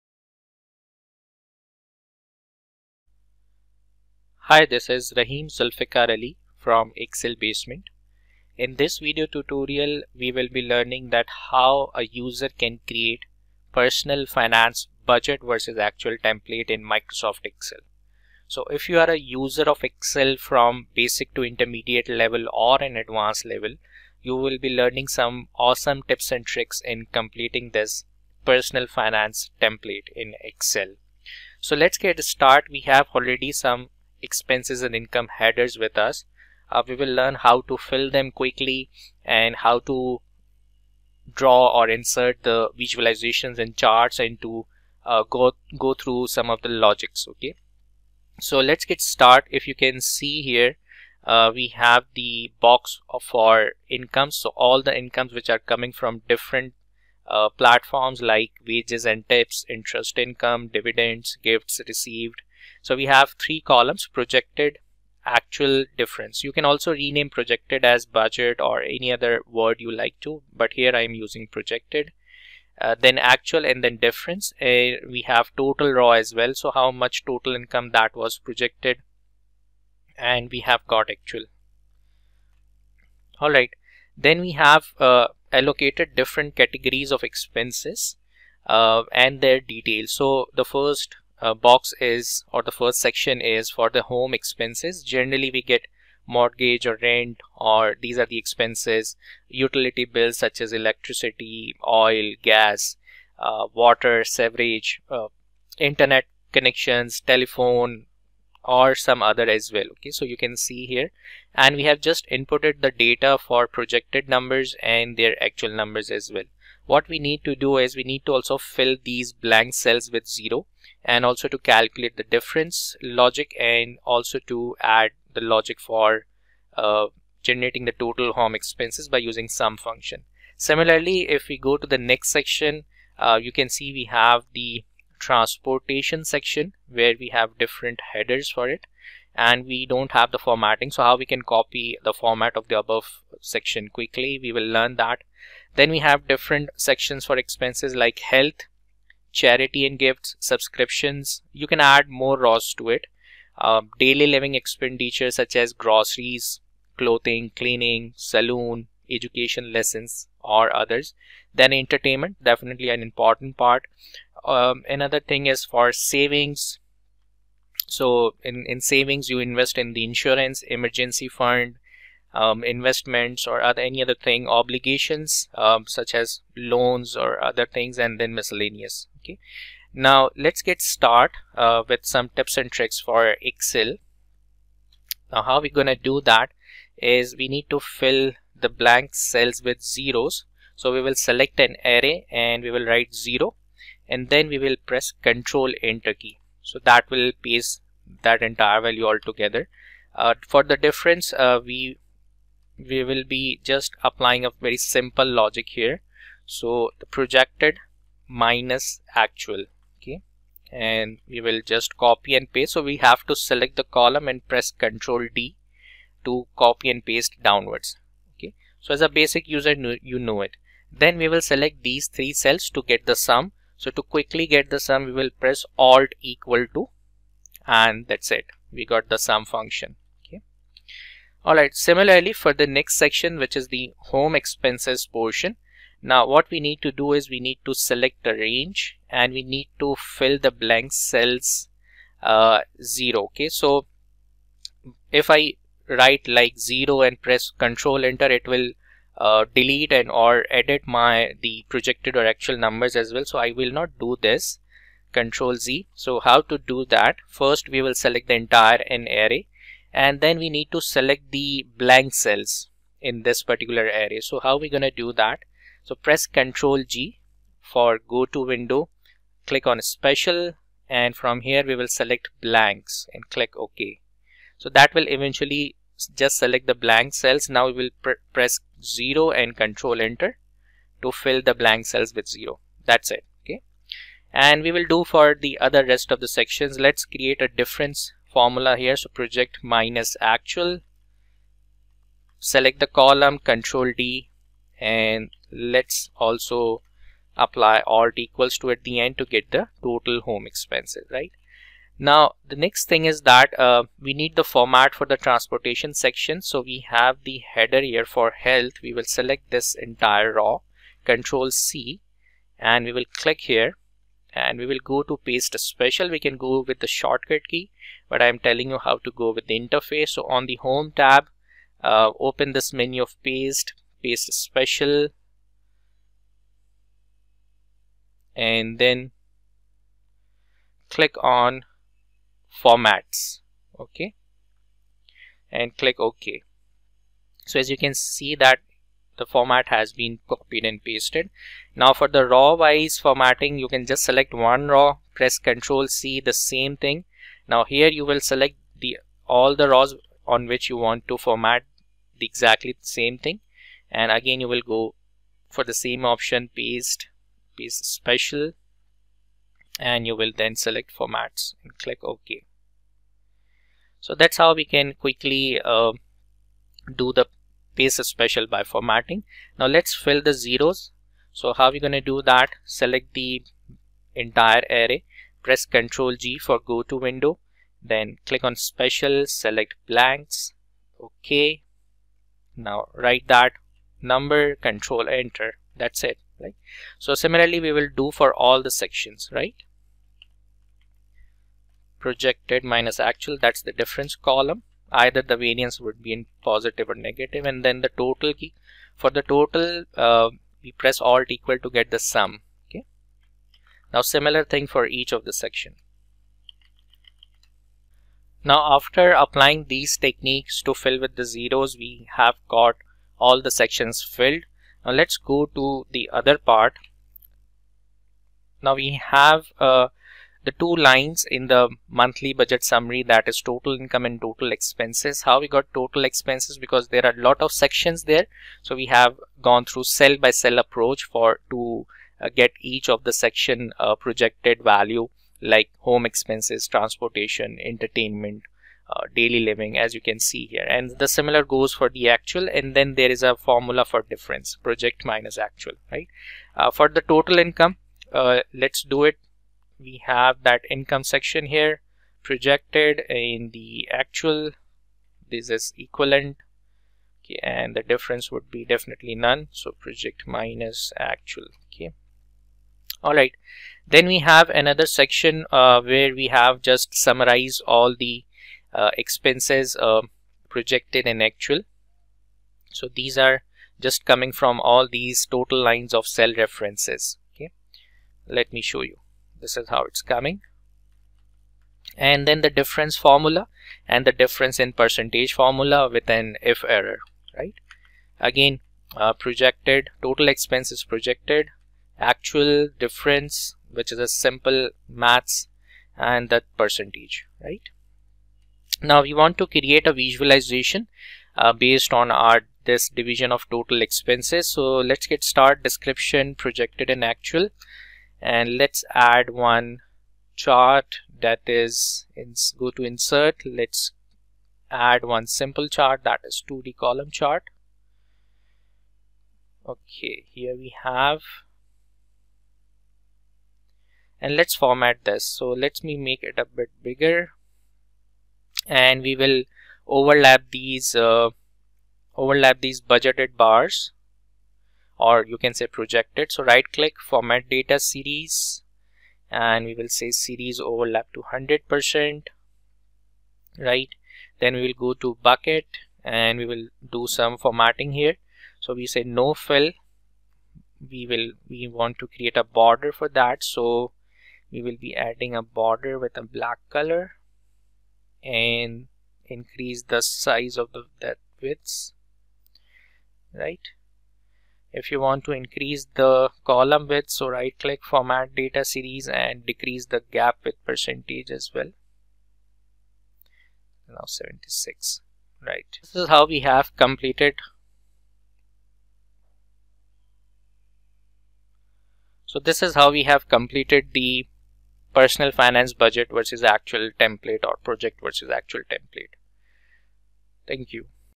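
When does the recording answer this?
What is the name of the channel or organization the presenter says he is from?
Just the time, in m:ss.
0:06.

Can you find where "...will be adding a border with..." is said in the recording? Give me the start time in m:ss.
9:14.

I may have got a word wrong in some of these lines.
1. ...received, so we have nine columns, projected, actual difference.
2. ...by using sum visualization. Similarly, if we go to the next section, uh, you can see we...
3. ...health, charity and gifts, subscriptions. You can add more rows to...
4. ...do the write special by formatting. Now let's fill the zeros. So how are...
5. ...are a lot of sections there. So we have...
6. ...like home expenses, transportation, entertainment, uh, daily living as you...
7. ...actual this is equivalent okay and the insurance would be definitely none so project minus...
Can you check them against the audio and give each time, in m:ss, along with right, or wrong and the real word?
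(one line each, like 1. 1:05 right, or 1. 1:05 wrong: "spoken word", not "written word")
1. 1:01 wrong: "three", not "nine"
2. 2:09 wrong: "function", not "visualization"
3. 2:28 right
4. 6:06 wrong: "paste", not "write"
5. 7:07 right
6. 7:15 right
7. 7:33 wrong: "difference", not "insurance".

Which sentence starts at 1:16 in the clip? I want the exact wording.
So how much total income that was projected and we have got actual.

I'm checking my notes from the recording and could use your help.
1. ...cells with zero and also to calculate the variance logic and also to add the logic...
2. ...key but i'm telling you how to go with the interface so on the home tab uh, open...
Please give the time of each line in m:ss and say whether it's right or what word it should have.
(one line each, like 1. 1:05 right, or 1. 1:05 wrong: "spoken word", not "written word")
1. 1:59 wrong: "difference", not "variance"
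2. 5:17 right.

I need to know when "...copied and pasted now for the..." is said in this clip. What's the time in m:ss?
5:40.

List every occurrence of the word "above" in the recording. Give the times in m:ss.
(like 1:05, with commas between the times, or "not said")
2:22.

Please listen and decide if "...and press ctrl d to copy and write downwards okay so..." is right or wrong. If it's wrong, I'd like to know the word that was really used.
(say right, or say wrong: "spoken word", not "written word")
wrong: "paste", not "write".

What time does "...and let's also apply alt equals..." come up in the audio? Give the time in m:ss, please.
4:54.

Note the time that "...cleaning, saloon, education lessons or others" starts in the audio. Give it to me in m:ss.
2:37.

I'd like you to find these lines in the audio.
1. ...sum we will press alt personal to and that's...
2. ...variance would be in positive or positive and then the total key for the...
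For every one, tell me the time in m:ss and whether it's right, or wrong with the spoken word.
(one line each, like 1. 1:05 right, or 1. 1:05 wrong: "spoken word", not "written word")
1. 3:44 wrong: "equal", not "personal"
2. 6:35 wrong: "negative", not "positive".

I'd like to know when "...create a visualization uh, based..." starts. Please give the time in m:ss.
8:19.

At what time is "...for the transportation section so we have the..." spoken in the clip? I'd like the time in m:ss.
5:04.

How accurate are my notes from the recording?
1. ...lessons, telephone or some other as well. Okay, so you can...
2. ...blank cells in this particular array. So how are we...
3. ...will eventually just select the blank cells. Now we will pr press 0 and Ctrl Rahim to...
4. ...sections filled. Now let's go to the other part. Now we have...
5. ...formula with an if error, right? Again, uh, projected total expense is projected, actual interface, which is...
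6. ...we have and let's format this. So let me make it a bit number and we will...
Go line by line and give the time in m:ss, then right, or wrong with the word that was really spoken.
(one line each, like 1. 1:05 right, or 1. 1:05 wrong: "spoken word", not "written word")
1. 1:46 wrong: "connections", not "lessons"
2. 4:21 right
3. 4:34 wrong: "Enter", not "Rahim"
4. 6:53 right
5. 8:05 wrong: "difference", not "interface"
6. 8:40 wrong: "bigger", not "number".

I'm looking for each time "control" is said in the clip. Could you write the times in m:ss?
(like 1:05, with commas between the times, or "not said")
3:15, 4:07, 4:15, 4:53, 5:11, 6:24.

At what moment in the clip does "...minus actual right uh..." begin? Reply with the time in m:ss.
7:25.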